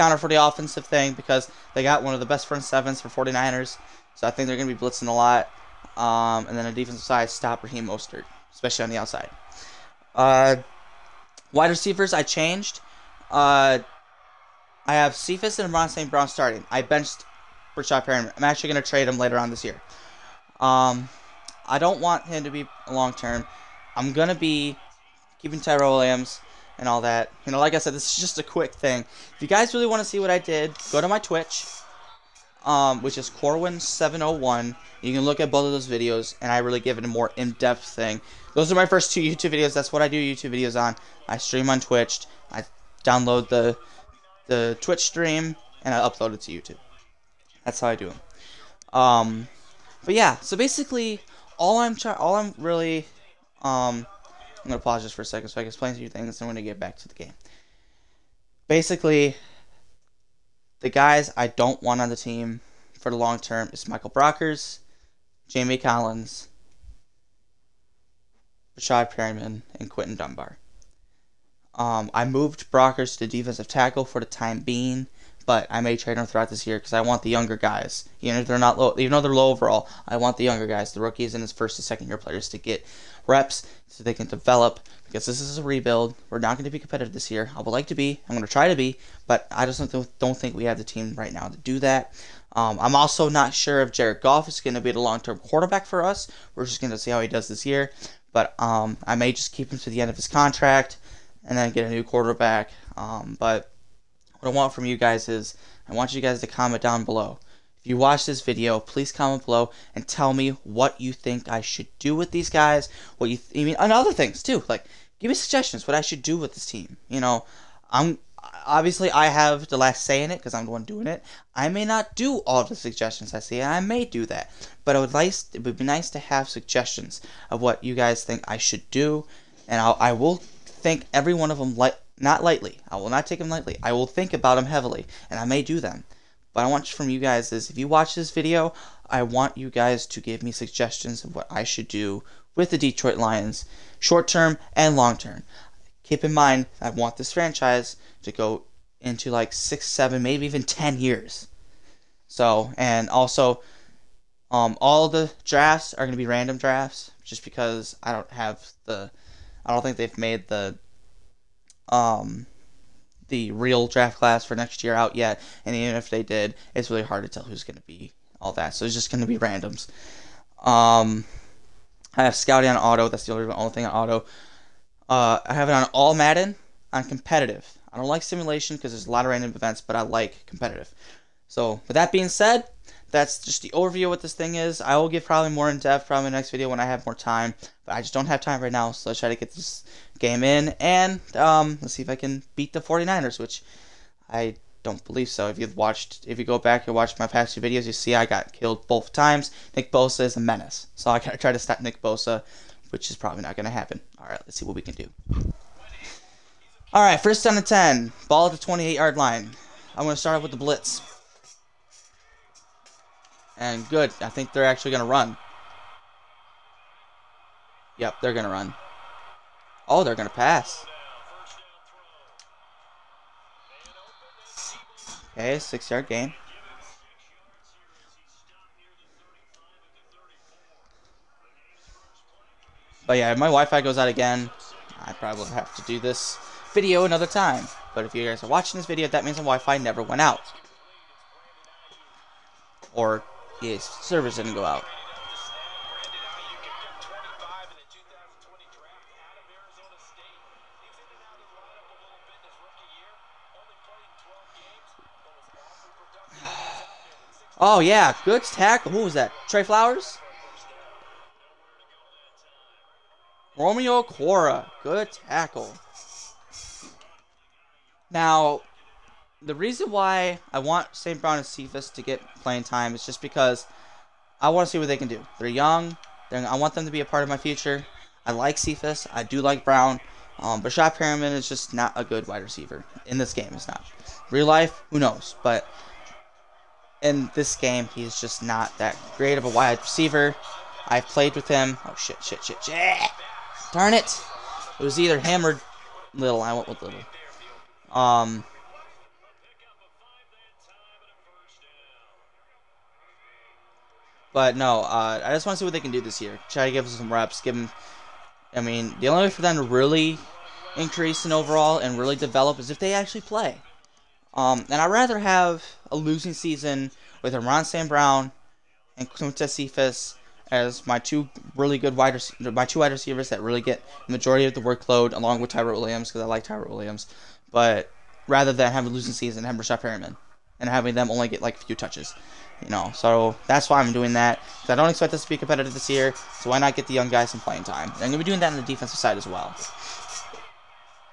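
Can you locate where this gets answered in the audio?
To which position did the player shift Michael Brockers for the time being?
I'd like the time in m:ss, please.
1:13.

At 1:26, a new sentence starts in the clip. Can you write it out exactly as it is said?
We're not going to be competitive this year.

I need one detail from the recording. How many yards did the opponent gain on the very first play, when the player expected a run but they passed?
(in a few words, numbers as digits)
6.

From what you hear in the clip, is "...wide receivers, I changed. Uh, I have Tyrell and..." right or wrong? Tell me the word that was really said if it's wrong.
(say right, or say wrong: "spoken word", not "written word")
wrong: "Cephus", not "Tyrell".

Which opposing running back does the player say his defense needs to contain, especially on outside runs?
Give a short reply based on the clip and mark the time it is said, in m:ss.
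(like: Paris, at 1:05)
Raheem Mostert, at 0:07.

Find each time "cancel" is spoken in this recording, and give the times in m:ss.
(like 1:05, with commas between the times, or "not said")
not said.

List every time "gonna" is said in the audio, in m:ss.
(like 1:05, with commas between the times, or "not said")
3:23, 3:30.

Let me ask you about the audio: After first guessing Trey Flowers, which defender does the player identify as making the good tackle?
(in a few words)
Romeo Okwara.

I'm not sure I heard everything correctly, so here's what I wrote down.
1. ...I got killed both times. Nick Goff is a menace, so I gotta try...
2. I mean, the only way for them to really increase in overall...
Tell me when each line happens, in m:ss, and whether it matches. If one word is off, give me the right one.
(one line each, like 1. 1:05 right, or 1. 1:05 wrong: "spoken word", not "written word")
1. 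3:18 wrong: "Bosa", not "Goff"
2. 5:08 right.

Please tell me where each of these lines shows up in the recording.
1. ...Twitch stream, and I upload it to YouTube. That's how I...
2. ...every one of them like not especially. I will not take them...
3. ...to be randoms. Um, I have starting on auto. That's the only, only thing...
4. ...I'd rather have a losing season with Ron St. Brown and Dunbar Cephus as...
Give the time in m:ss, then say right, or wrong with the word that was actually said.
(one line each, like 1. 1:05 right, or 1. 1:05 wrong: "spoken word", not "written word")
1. 0:44 right
2. 2:11 wrong: "lightly", not "especially"
3. 2:49 wrong: "scouting", not "starting"
4. 5:14 wrong: "Clint", not "Dunbar".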